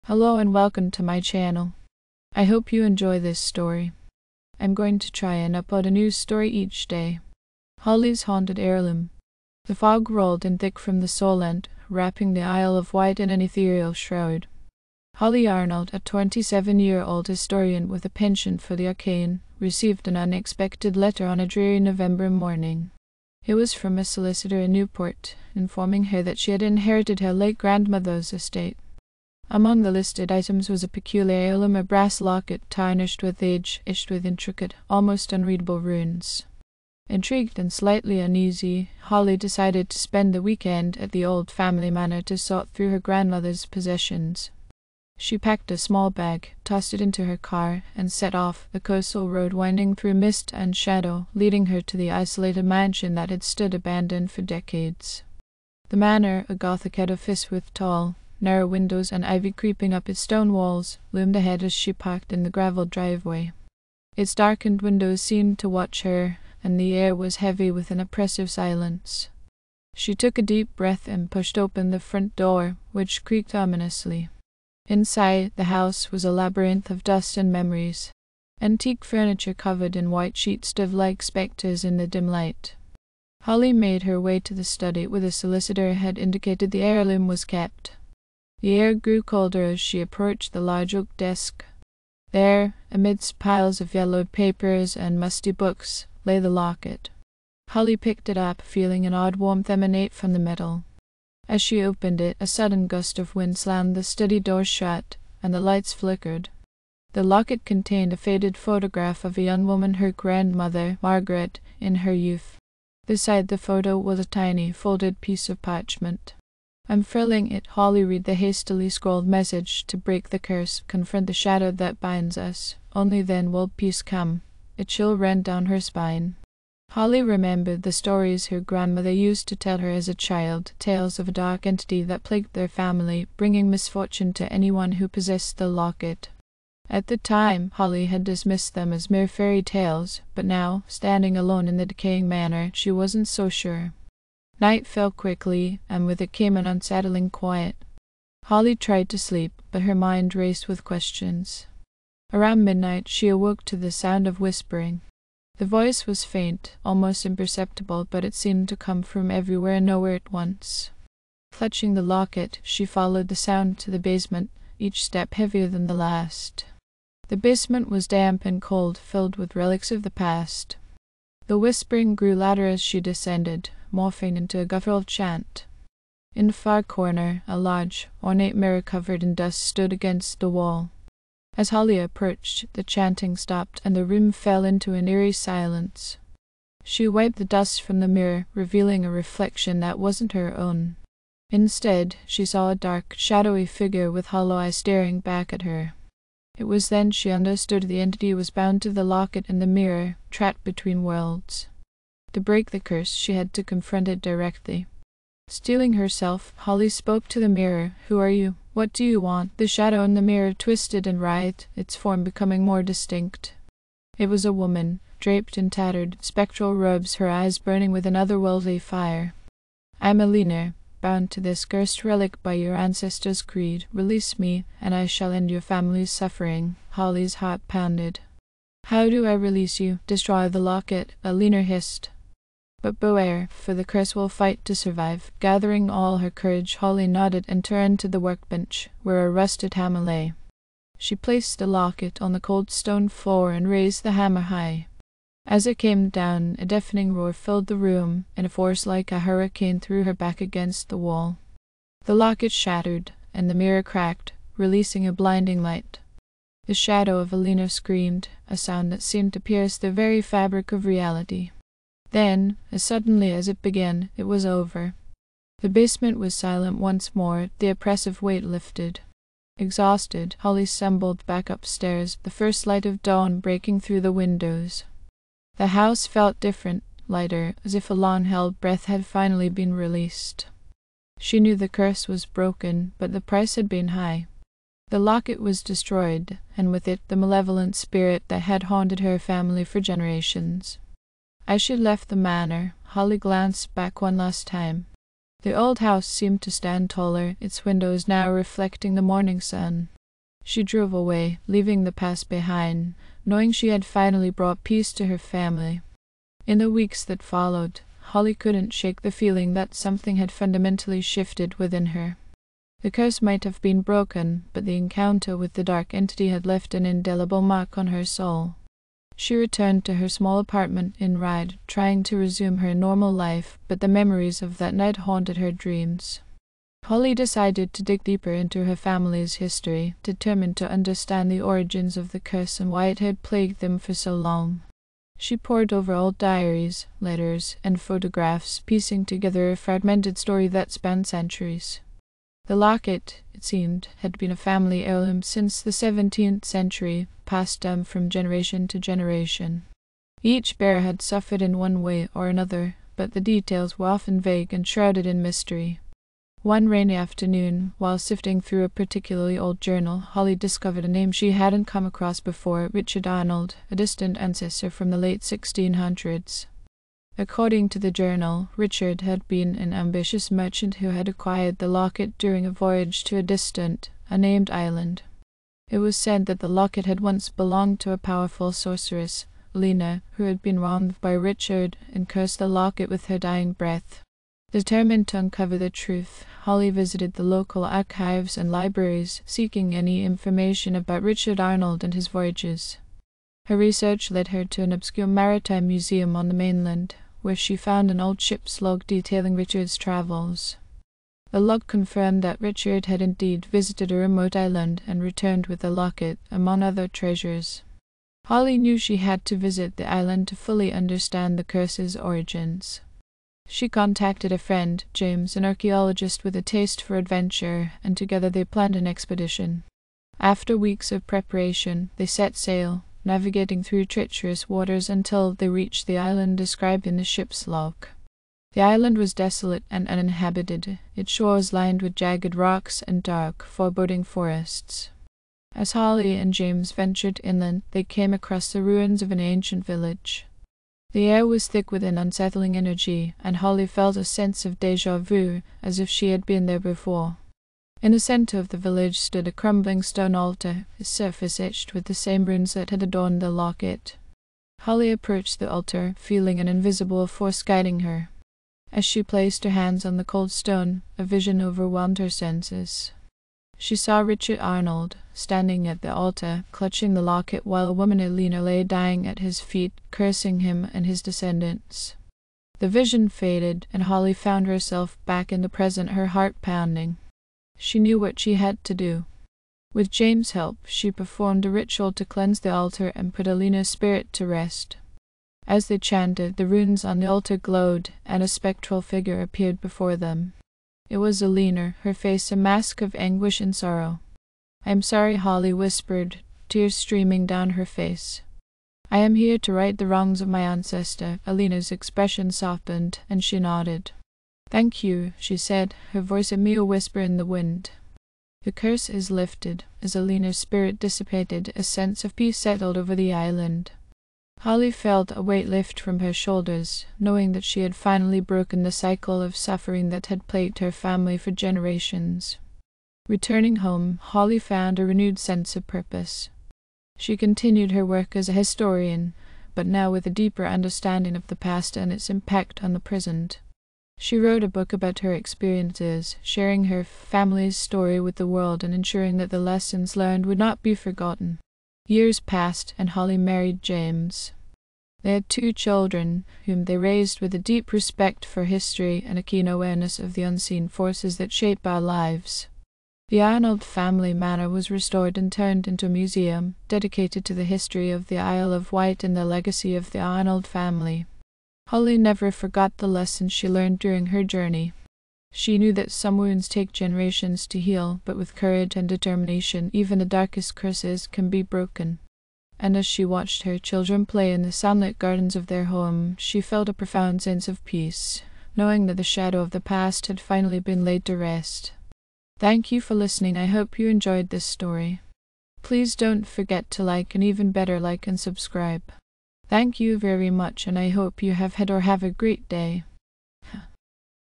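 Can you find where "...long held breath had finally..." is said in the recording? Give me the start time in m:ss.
4:37.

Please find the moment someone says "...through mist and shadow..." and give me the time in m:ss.
0:49.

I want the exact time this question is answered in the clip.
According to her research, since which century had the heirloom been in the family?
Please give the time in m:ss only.
5:45.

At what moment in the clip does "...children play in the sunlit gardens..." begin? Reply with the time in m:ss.
9:33.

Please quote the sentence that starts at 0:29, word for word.
Among the listed items was a peculiarium, a brass locket tarnished with age, etched with intricate, almost unreadable runes.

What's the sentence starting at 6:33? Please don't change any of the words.
Her research led her to an obscure maritime museum on the mainland, where she found an old ship's log detailing Richard's travels.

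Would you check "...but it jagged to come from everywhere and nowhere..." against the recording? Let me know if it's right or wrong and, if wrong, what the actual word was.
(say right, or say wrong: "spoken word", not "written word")
wrong: "seemed", not "jagged".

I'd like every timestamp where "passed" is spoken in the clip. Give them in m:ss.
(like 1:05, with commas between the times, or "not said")
5:47, 9:02.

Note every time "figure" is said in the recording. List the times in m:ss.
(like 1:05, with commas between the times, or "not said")
3:13, 8:08.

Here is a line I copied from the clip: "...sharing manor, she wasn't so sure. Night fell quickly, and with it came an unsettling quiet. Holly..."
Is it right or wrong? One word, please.
wrong.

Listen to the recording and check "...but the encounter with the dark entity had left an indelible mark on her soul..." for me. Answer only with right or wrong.
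right.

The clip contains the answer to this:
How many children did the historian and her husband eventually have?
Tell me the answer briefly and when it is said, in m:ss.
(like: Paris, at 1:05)
2, at 9:05.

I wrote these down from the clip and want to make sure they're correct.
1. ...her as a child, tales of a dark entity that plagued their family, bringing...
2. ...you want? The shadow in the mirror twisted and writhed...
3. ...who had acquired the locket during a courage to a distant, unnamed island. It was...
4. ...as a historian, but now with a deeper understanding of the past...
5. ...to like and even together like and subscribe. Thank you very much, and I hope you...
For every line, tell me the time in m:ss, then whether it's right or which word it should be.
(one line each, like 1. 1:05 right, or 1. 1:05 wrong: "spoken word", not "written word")
1. 2:09 right
2. 3:29 right
3. 6:10 wrong: "voyage", not "courage"
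4. 8:48 right
5. 9:46 wrong: "better", not "together".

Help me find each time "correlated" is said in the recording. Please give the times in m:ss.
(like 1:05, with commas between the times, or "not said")
not said.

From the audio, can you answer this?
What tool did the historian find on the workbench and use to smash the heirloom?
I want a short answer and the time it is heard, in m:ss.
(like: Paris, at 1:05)
A rusted hammer, at 3:59.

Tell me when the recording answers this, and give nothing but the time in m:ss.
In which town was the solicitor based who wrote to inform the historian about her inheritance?
0:24.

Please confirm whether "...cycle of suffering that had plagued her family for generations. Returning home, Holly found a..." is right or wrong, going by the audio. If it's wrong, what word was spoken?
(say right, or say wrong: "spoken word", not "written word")
right.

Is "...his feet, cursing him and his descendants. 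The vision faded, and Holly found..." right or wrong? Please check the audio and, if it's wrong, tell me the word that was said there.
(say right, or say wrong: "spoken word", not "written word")
right.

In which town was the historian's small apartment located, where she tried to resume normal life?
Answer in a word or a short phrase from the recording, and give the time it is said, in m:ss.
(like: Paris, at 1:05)
Ryde, at 5:21.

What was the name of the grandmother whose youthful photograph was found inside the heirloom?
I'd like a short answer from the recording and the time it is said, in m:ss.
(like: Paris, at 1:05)
Margaret, at 1:51.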